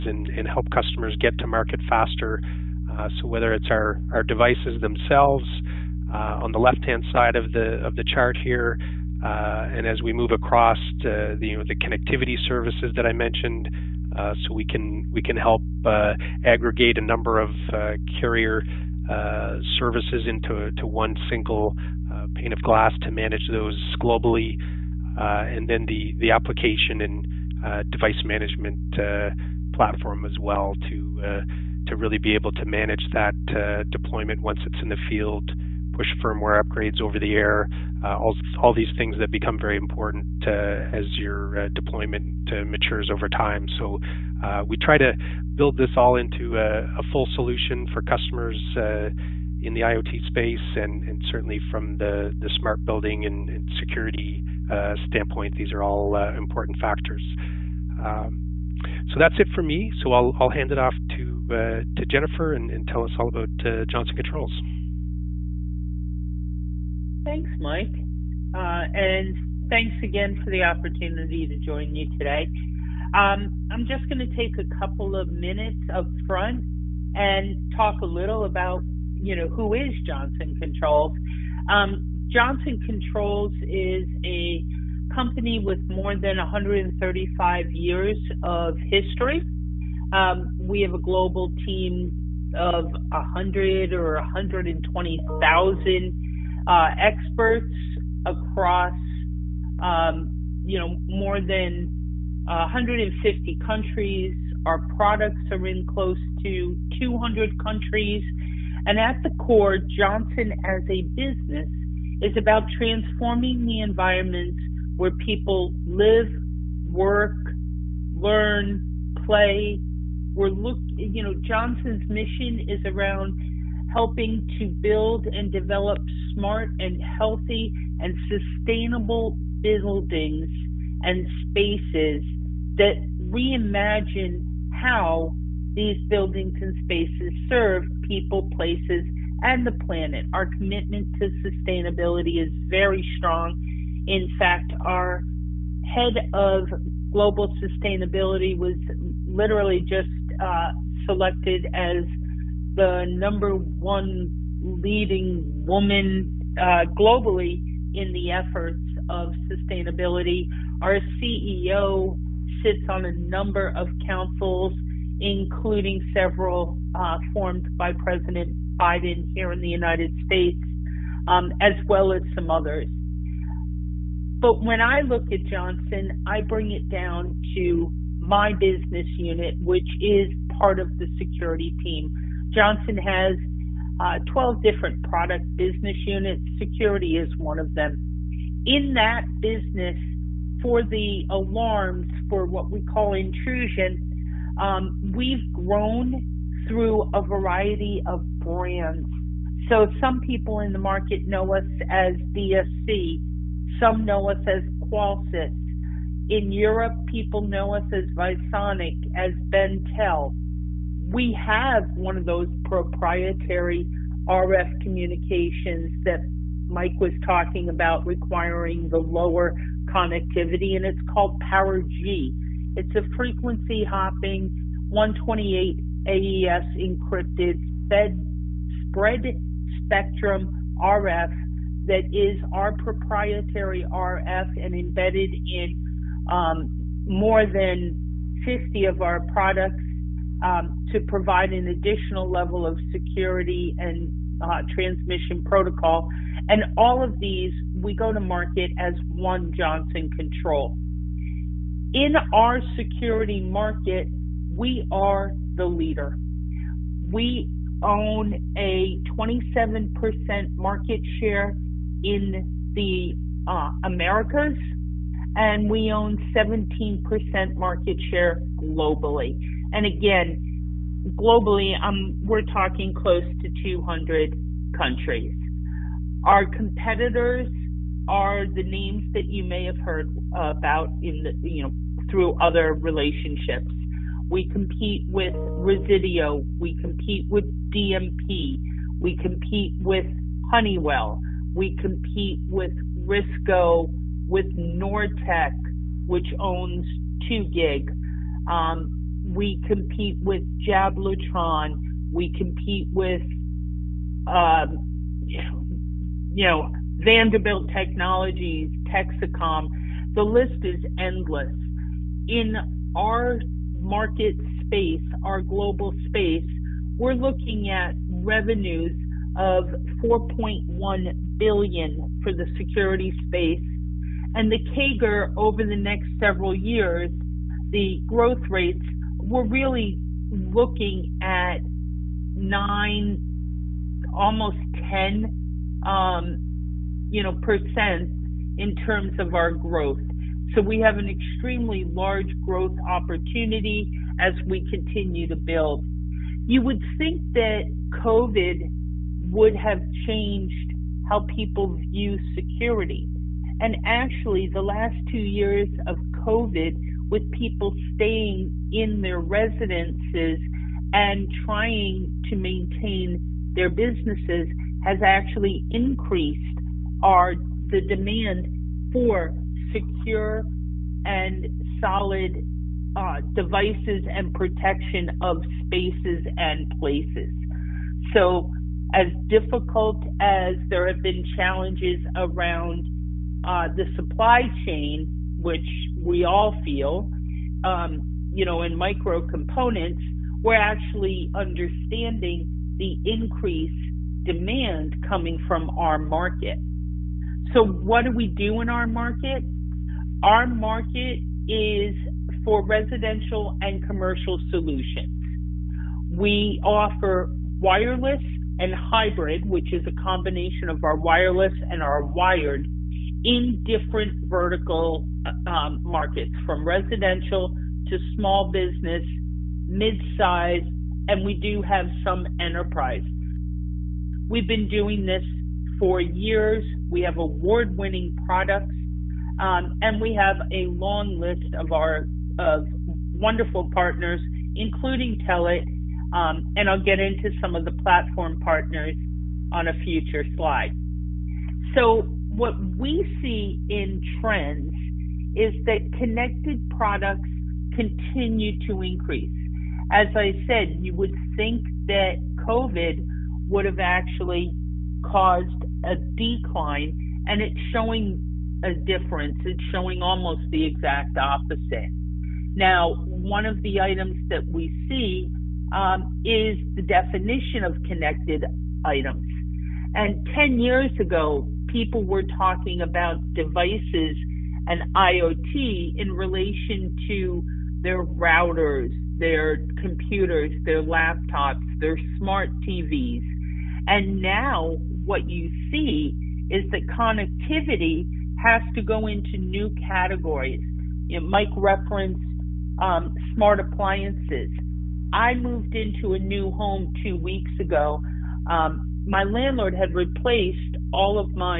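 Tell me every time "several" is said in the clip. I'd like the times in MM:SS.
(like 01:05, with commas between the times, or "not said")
02:46, 05:26.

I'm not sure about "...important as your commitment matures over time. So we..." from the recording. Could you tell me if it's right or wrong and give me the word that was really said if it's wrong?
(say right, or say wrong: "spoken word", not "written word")
wrong: "deployment", not "commitment".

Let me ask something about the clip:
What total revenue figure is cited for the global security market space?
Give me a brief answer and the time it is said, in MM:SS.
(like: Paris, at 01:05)
4.1 billion, at 05:20.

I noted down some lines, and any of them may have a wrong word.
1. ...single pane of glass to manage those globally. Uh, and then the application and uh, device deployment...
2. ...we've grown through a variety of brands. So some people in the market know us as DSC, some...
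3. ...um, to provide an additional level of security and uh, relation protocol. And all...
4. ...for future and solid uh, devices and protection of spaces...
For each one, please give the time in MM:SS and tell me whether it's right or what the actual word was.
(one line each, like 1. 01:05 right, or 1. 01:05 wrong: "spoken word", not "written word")
1. 00:21 wrong: "management", not "deployment"
2. 03:15 right
3. 04:00 wrong: "transmission", not "relation"
4. 06:08 wrong: "secure", not "future".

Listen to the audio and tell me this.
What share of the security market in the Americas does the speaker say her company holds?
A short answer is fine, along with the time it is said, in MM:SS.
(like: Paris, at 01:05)
27%, at 04:19.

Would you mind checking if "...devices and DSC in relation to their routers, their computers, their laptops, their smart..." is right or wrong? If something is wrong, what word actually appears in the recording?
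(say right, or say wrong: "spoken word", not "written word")
wrong: "IoT", not "DSC".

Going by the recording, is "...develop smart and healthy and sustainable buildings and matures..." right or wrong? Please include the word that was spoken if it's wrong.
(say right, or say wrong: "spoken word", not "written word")
wrong: "spaces", not "matures".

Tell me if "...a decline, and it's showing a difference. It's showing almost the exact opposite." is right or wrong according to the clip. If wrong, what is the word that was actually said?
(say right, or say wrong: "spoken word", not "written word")
right.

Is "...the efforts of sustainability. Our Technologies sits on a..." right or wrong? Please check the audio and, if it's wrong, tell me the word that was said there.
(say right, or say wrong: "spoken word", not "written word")
wrong: "CEO", not "Technologies".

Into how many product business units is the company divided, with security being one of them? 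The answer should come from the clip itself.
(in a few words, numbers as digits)
12.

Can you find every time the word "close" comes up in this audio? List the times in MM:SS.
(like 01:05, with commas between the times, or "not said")
01:45, 04:32.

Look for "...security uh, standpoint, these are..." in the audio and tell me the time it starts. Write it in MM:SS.
00:53.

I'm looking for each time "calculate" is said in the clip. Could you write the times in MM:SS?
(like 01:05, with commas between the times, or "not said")
not said.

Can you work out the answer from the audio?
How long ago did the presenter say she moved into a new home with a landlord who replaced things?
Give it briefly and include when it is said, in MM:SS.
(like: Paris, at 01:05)
2 weeks ago, at 08:17.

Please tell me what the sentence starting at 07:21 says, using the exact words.
So what we see in trends is that connected products continue to increase.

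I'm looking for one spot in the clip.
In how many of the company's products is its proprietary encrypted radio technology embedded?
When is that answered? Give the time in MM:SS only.
03:57.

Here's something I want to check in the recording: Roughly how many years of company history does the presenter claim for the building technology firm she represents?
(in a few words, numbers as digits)
135 years.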